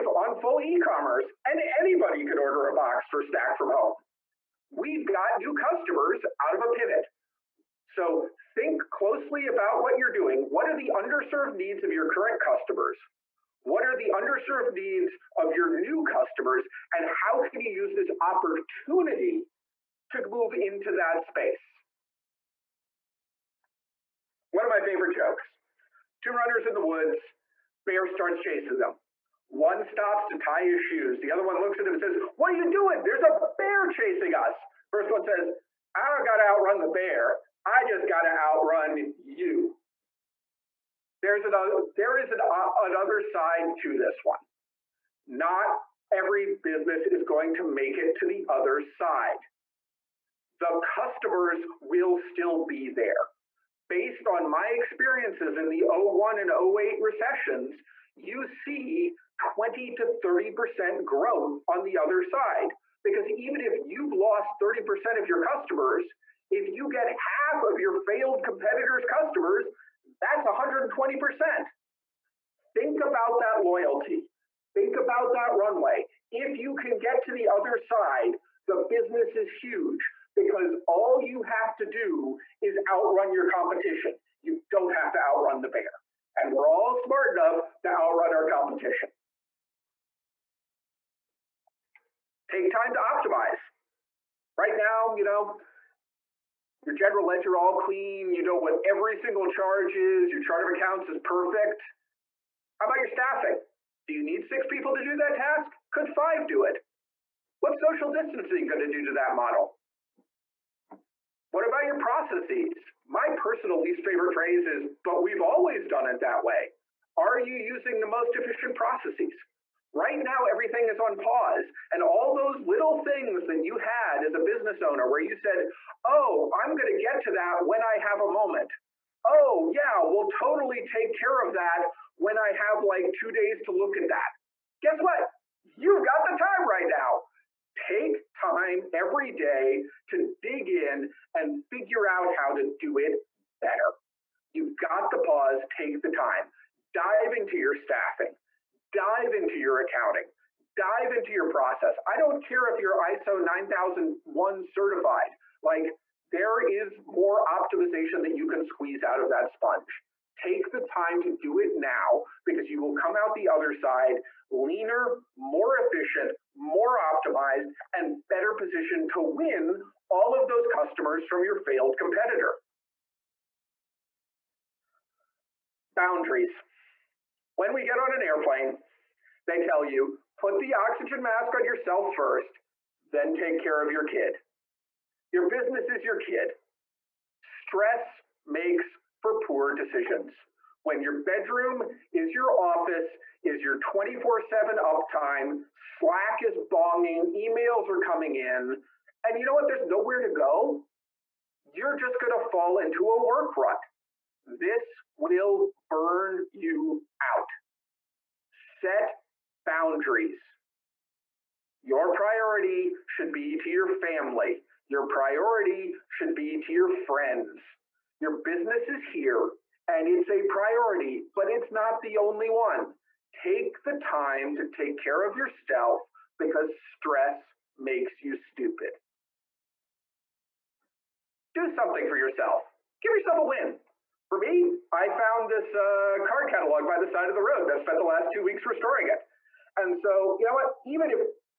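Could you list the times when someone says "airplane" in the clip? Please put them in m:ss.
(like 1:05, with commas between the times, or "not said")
2:58.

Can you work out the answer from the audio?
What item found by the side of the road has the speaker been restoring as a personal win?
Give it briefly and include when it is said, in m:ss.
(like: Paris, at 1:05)
card catalog, at 3:56.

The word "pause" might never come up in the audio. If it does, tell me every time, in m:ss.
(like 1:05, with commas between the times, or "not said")
2:01, 2:25.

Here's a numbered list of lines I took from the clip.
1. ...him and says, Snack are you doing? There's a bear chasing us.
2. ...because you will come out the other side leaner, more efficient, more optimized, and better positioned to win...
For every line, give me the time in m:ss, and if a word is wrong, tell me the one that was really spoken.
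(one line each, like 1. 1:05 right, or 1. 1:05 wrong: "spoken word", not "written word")
1. 0:31 wrong: "What", not "Snack"
2. 2:42 right.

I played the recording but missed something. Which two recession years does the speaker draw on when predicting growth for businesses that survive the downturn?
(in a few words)
01 and 08.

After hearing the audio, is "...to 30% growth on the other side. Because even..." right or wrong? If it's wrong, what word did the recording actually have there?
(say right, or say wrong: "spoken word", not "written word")
right.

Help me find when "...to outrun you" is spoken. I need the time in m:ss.
0:38.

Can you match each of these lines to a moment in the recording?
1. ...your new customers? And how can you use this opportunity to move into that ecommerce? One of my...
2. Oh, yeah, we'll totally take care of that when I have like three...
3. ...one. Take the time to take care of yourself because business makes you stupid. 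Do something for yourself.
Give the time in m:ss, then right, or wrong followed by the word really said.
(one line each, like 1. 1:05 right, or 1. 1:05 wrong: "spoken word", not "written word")
1. 0:15 wrong: "space", not "ecommerce"
2. 2:09 wrong: "two", not "three"
3. 3:42 wrong: "stress", not "business".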